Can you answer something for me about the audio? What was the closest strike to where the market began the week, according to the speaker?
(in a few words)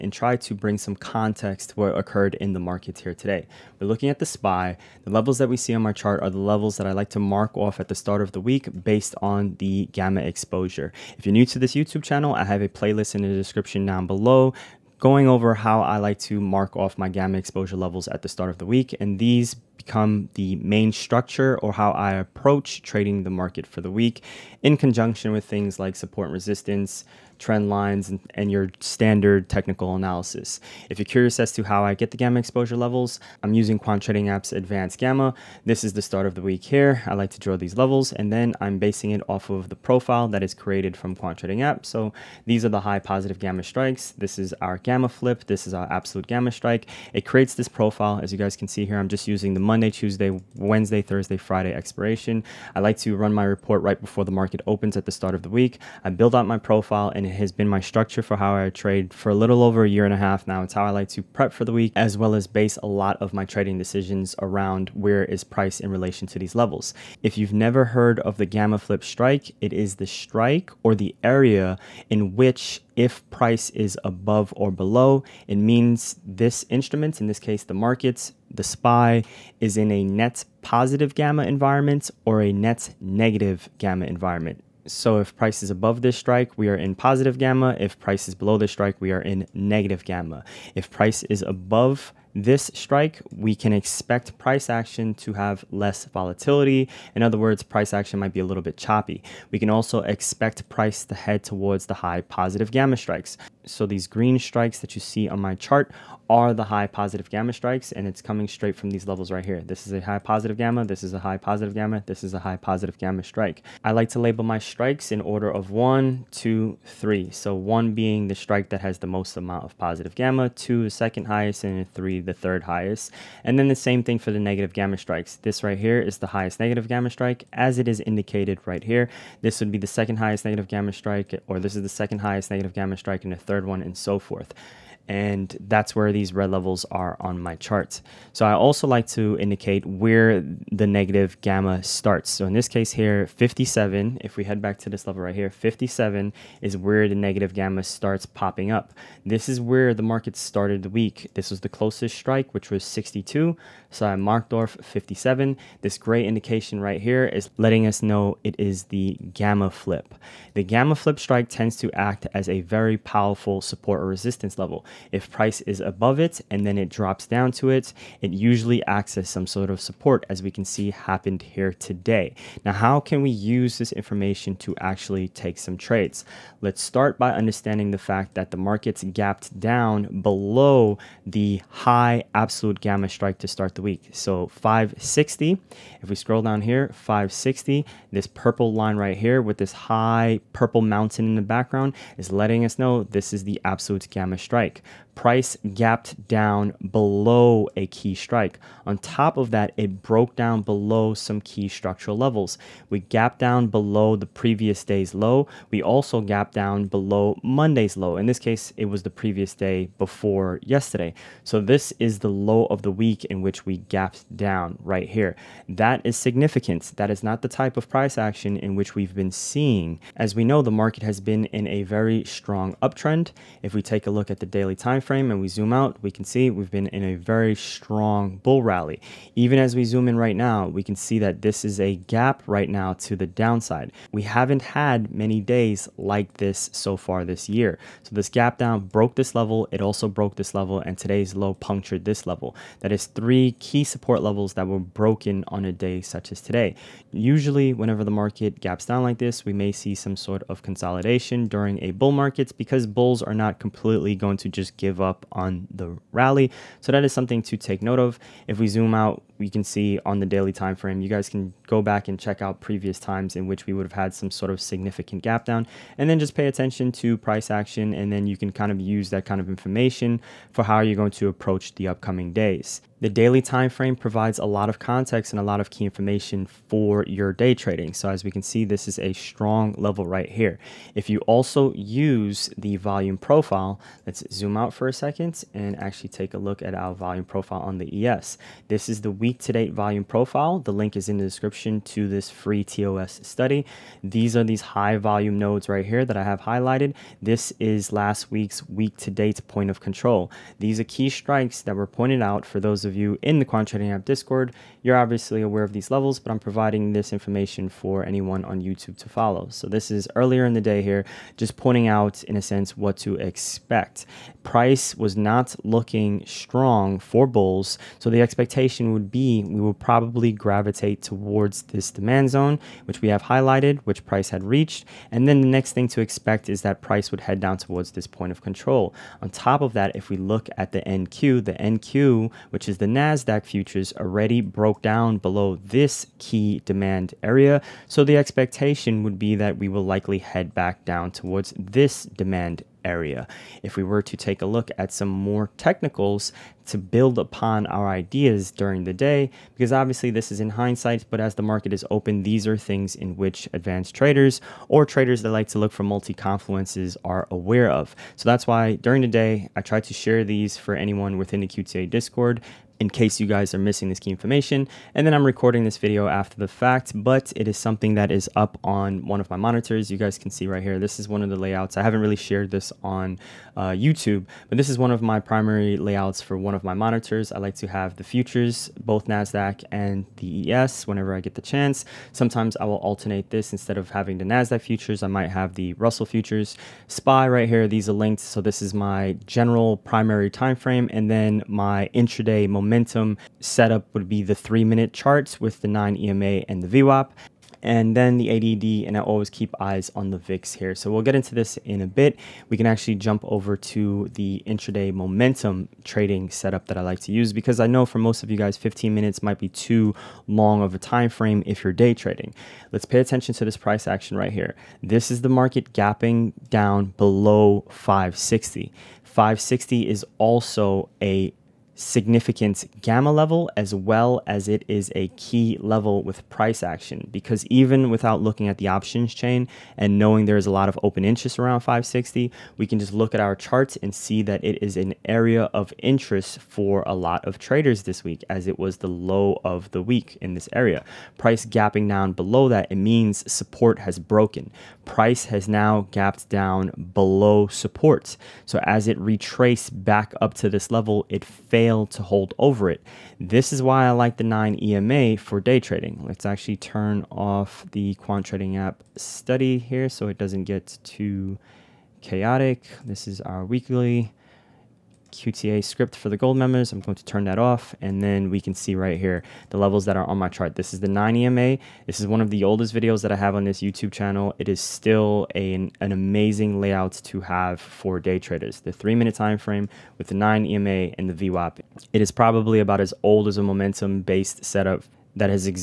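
62.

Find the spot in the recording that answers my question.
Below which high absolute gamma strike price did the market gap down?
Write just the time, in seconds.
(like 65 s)
184 s.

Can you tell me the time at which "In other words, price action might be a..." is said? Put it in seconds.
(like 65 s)
97 s.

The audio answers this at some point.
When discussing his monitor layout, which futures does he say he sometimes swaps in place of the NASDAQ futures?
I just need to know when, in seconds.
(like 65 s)
385 s.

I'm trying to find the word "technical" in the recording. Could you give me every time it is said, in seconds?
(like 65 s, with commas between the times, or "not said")
29 s, 345 s.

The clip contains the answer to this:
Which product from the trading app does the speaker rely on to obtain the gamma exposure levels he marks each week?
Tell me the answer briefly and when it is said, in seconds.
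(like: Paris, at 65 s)
Advanced Gamma, at 34 s.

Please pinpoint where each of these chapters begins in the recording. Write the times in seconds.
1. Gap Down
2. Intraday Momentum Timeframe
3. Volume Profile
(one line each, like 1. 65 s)
1. 171 s
2. 401 s
3. 281 s.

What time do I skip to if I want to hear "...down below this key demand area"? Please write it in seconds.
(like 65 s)
334 s.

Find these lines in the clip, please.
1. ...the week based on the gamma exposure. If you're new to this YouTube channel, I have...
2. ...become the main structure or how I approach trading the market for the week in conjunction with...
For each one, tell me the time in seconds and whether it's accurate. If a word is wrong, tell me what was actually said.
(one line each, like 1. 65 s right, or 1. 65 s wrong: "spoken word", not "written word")
1. 8 s right
2. 19 s right.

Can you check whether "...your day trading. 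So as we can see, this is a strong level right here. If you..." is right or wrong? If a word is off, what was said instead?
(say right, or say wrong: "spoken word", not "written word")
right.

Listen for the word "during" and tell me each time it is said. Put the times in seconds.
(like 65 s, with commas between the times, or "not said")
251 s, 348 s, 358 s.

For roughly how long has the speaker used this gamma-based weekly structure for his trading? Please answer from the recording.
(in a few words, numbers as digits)
a little over a year and a half.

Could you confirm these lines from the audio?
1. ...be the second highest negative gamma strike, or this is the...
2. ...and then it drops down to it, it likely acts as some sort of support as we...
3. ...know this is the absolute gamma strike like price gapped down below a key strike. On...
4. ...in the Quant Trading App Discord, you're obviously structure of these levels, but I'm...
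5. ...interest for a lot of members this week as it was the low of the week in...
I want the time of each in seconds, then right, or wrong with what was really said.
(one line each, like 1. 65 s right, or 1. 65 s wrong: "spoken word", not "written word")
1. 129 s right
2. 166 s wrong: "usually", not "likely"
3. 192 s right
4. 303 s wrong: "aware", not "structure"
5. 435 s wrong: "traders", not "members".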